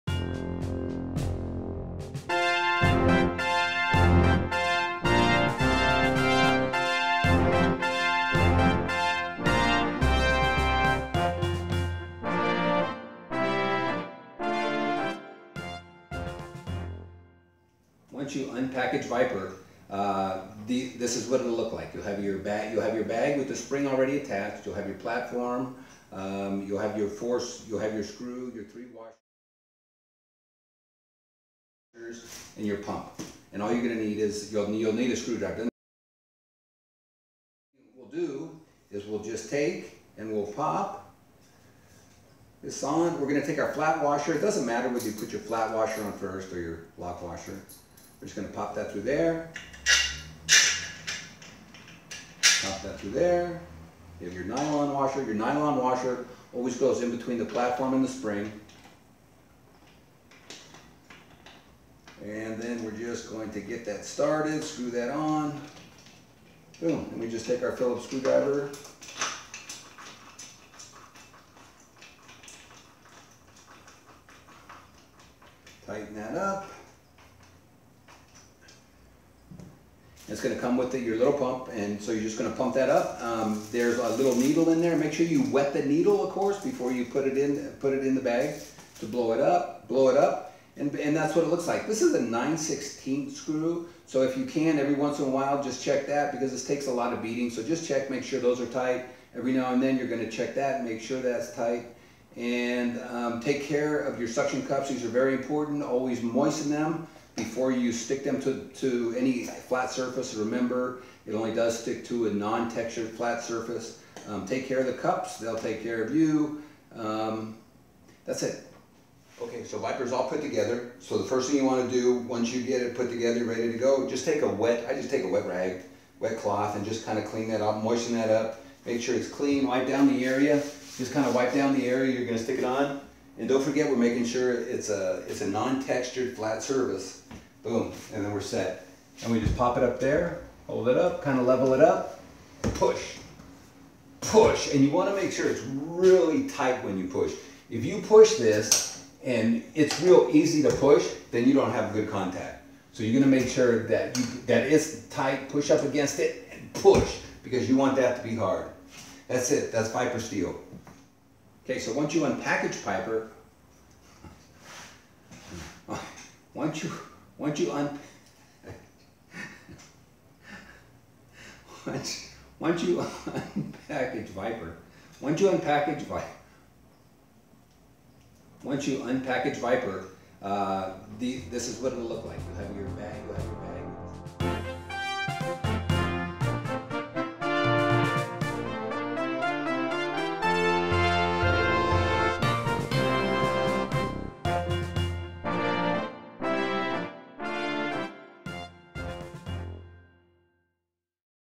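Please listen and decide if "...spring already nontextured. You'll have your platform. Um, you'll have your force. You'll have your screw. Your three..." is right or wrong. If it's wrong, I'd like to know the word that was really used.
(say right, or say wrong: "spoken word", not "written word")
wrong: "attached", not "nontextured".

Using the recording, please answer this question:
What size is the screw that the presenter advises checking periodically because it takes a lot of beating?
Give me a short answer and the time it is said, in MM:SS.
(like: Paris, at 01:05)
916, at 01:32.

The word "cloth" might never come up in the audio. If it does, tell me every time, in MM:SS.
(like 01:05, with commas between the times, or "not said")
02:06.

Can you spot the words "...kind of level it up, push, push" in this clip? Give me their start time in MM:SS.
02:21.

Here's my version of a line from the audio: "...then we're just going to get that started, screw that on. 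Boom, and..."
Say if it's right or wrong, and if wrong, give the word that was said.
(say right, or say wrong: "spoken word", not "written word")
right.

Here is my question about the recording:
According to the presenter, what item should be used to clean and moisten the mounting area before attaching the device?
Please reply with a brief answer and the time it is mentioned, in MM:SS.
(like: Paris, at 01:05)
Wet rag, at 02:05.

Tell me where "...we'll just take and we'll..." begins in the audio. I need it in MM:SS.
00:39.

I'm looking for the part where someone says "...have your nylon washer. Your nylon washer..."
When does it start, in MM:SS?
00:54.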